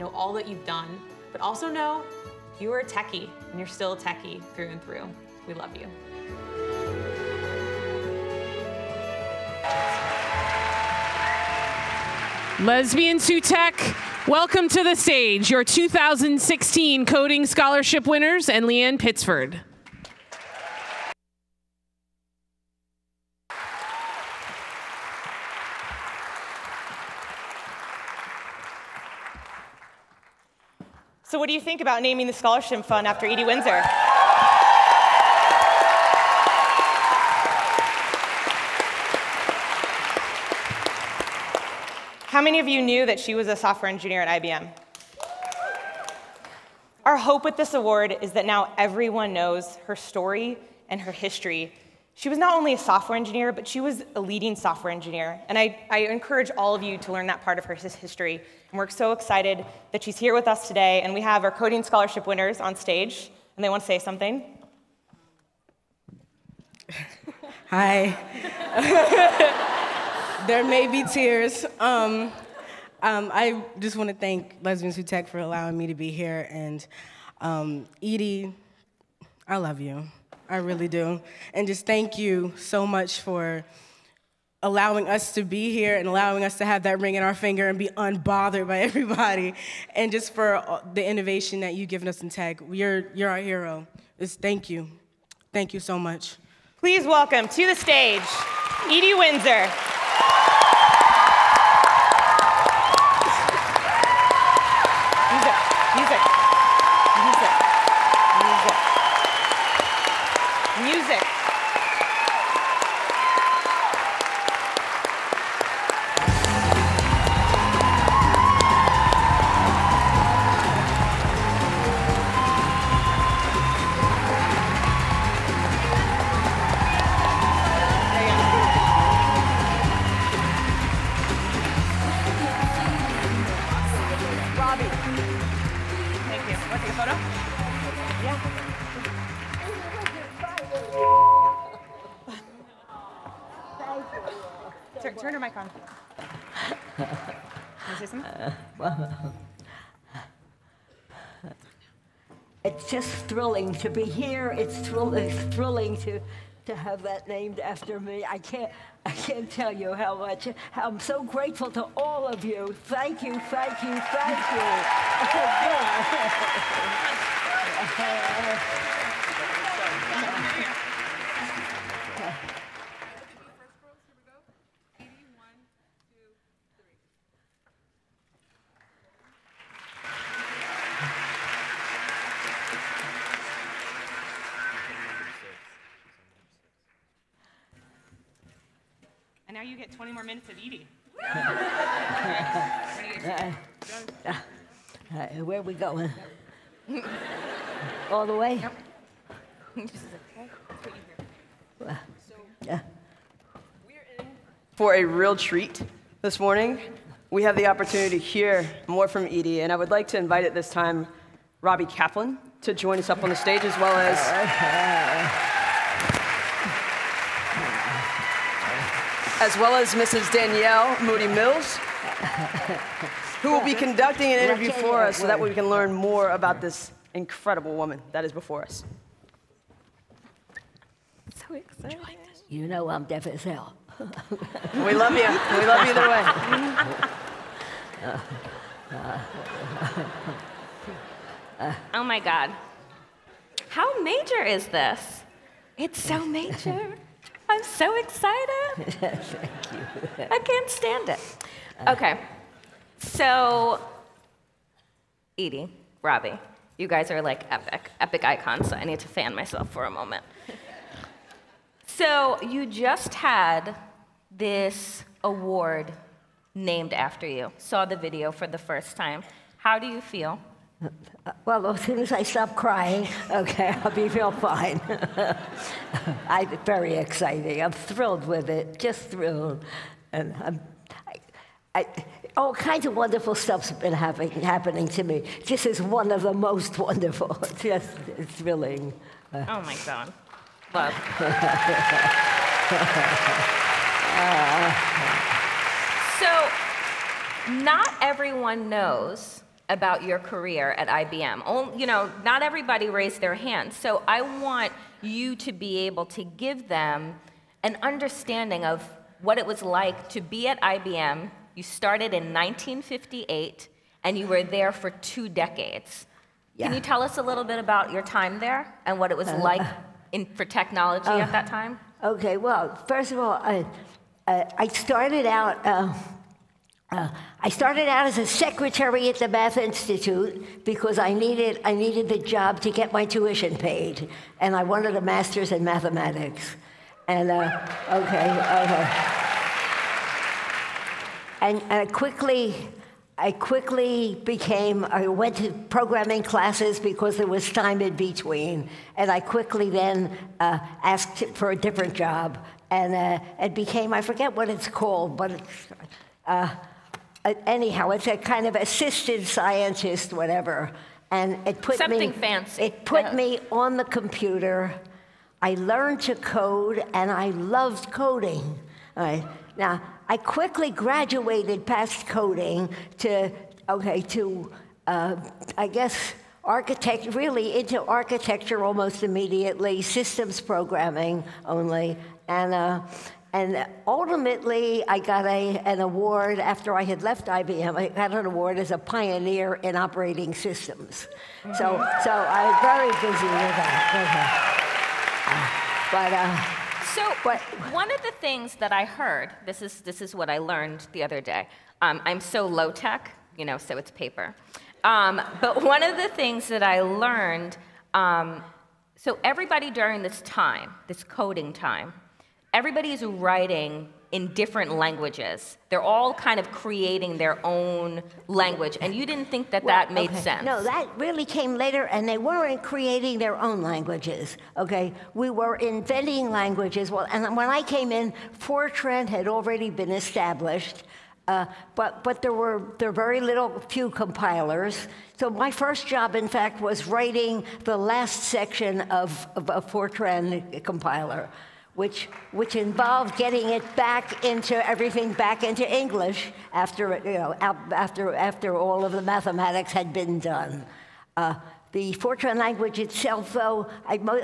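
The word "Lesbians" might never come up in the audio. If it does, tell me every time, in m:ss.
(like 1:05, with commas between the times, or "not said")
0:12, 1:14.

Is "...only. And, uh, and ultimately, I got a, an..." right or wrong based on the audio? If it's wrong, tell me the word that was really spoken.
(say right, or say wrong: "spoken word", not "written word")
right.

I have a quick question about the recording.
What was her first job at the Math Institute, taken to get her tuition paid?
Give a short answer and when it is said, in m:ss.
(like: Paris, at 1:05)
Secretary, at 5:28.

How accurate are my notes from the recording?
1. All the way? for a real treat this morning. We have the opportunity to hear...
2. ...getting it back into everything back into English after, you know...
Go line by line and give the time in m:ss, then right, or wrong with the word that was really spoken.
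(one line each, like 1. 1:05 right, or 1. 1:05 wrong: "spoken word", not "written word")
1. 3:18 right
2. 7:23 right.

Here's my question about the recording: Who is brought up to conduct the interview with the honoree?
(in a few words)
Danielle Moodie-Mills.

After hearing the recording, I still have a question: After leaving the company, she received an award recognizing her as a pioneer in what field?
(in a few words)
Operating systems.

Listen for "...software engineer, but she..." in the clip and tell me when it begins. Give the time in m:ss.
0:52.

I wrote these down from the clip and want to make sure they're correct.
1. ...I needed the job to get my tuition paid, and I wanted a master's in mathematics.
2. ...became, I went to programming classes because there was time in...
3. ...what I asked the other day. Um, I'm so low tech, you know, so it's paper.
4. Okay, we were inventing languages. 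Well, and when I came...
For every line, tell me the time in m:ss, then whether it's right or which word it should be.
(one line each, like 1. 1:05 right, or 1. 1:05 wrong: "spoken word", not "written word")
1. 5:31 right
2. 5:44 right
3. 6:40 wrong: "learned", not "asked"
4. 7:04 right.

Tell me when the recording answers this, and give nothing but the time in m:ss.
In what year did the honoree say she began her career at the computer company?
5:12.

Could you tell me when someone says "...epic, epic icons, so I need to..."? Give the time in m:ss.
4:17.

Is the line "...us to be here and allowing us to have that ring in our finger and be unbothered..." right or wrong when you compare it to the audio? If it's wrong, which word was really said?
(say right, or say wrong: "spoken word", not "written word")
right.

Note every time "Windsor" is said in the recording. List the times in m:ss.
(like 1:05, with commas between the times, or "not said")
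0:33, 1:39.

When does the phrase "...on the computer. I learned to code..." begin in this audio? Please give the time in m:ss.
6:03.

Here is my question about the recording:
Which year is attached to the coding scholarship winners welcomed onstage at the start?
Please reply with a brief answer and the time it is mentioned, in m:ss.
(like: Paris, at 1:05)
2016, at 0:15.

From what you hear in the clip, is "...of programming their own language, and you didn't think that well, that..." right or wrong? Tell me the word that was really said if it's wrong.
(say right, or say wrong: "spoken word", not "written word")
wrong: "creating", not "programming".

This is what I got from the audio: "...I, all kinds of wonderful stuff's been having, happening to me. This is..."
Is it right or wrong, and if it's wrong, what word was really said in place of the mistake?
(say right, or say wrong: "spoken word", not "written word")
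right.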